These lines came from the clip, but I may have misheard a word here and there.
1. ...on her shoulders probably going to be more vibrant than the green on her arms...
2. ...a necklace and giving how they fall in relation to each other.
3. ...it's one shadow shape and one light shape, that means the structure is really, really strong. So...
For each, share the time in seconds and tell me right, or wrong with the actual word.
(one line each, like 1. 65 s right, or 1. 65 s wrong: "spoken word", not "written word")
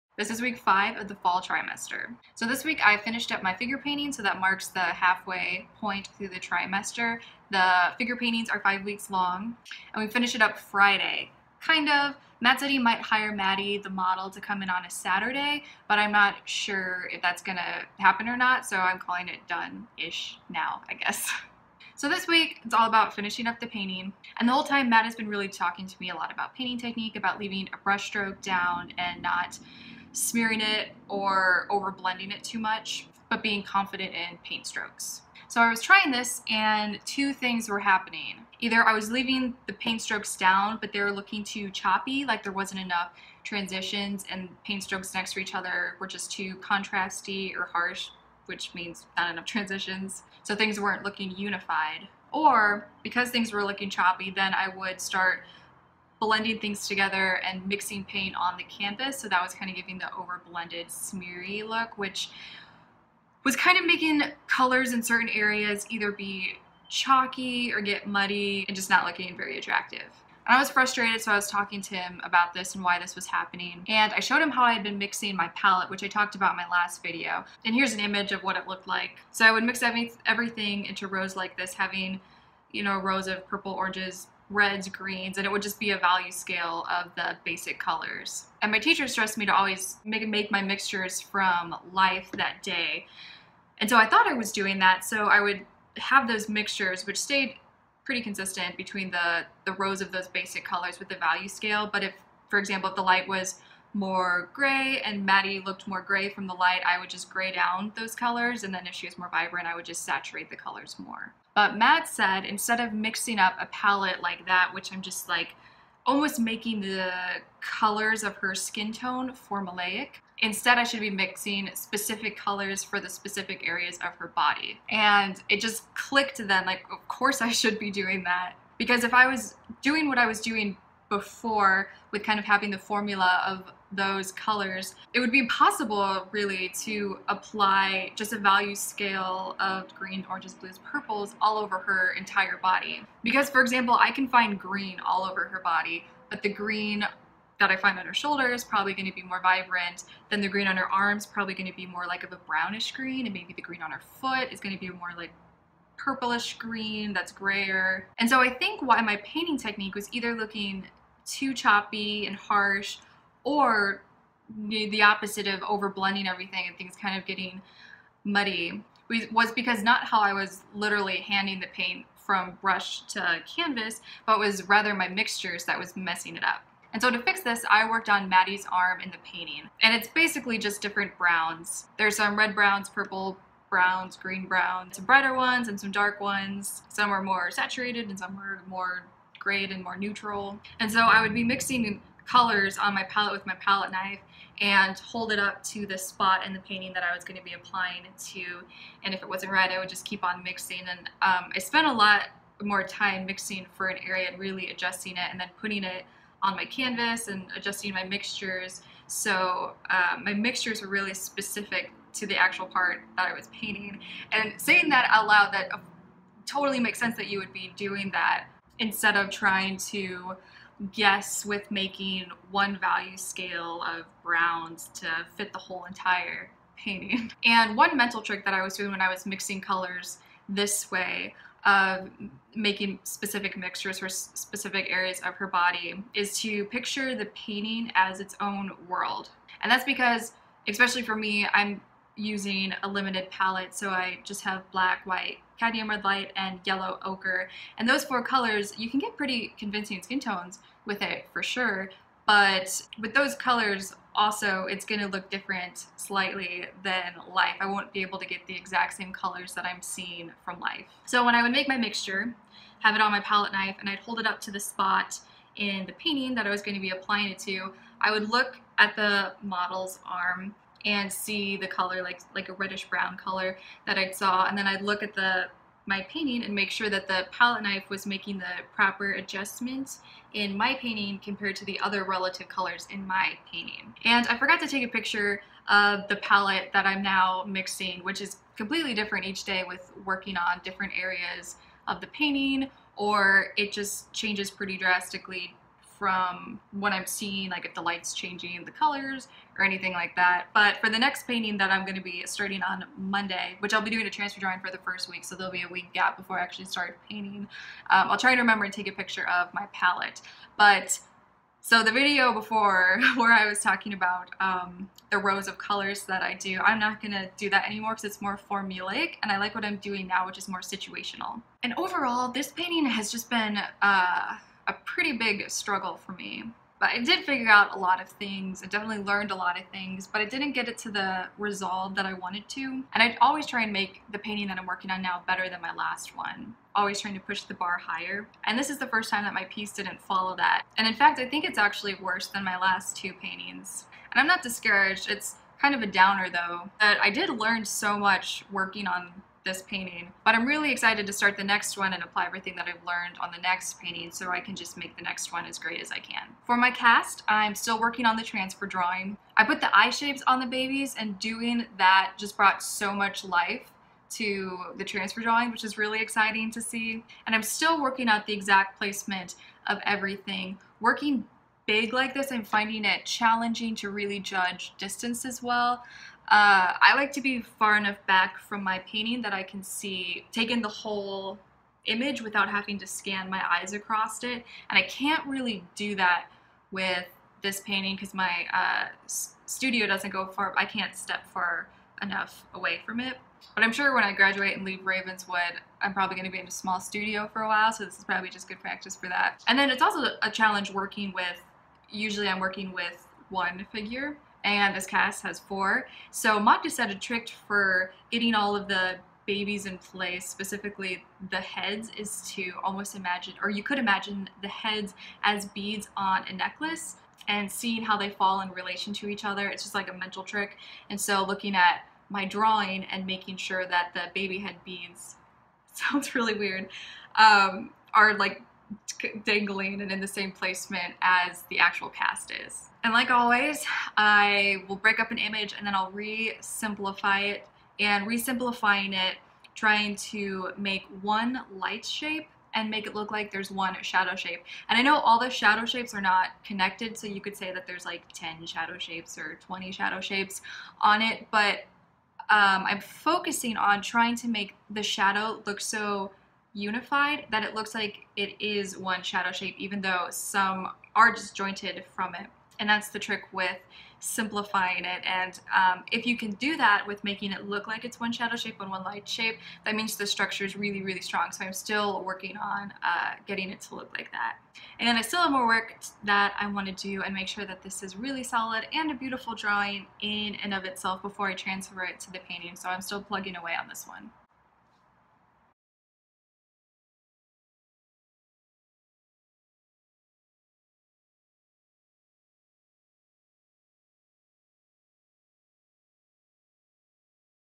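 1. 147 s right
2. 416 s wrong: "seeing", not "giving"
3. 467 s right.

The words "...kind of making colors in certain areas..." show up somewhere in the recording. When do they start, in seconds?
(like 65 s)
63 s.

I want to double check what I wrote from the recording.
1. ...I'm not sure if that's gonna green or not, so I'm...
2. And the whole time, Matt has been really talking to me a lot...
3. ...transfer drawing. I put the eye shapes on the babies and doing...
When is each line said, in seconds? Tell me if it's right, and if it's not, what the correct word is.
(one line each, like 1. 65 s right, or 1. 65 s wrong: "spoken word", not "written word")
1. 15 s wrong: "happen", not "green"
2. 24 s right
3. 358 s right.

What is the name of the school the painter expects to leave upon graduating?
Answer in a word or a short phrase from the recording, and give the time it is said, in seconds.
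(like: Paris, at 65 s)
Ravenswood, at 394 s.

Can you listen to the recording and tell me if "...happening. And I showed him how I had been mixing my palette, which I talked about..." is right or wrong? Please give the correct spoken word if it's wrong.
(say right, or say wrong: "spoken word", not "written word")
right.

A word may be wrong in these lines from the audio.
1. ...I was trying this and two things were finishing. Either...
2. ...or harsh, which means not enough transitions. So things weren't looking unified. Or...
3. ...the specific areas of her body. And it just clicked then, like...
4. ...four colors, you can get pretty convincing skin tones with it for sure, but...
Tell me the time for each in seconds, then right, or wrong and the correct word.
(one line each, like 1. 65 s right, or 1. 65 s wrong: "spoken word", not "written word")
1. 35 s wrong: "happening", not "finishing"
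2. 47 s right
3. 123 s right
4. 248 s right.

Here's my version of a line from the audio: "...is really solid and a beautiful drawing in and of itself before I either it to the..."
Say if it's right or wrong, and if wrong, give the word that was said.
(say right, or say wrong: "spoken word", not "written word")
wrong: "transfer", not "either".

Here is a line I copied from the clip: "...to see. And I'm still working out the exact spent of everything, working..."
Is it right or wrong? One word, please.
wrong.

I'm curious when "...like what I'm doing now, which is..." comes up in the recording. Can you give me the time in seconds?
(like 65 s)
319 s.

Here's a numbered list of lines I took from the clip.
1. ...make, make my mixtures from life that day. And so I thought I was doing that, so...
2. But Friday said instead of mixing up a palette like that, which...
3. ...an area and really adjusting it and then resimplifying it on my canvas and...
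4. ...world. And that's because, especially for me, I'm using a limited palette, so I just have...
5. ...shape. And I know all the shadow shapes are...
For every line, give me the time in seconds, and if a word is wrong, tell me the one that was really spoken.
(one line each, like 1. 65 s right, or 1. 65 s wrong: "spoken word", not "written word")
1. 90 s right
2. 111 s wrong: "Matt", not "Friday"
3. 203 s wrong: "putting", not "resimplifying"
4. 238 s right
5. 444 s right.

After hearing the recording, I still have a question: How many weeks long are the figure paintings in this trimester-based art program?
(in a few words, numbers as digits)
5.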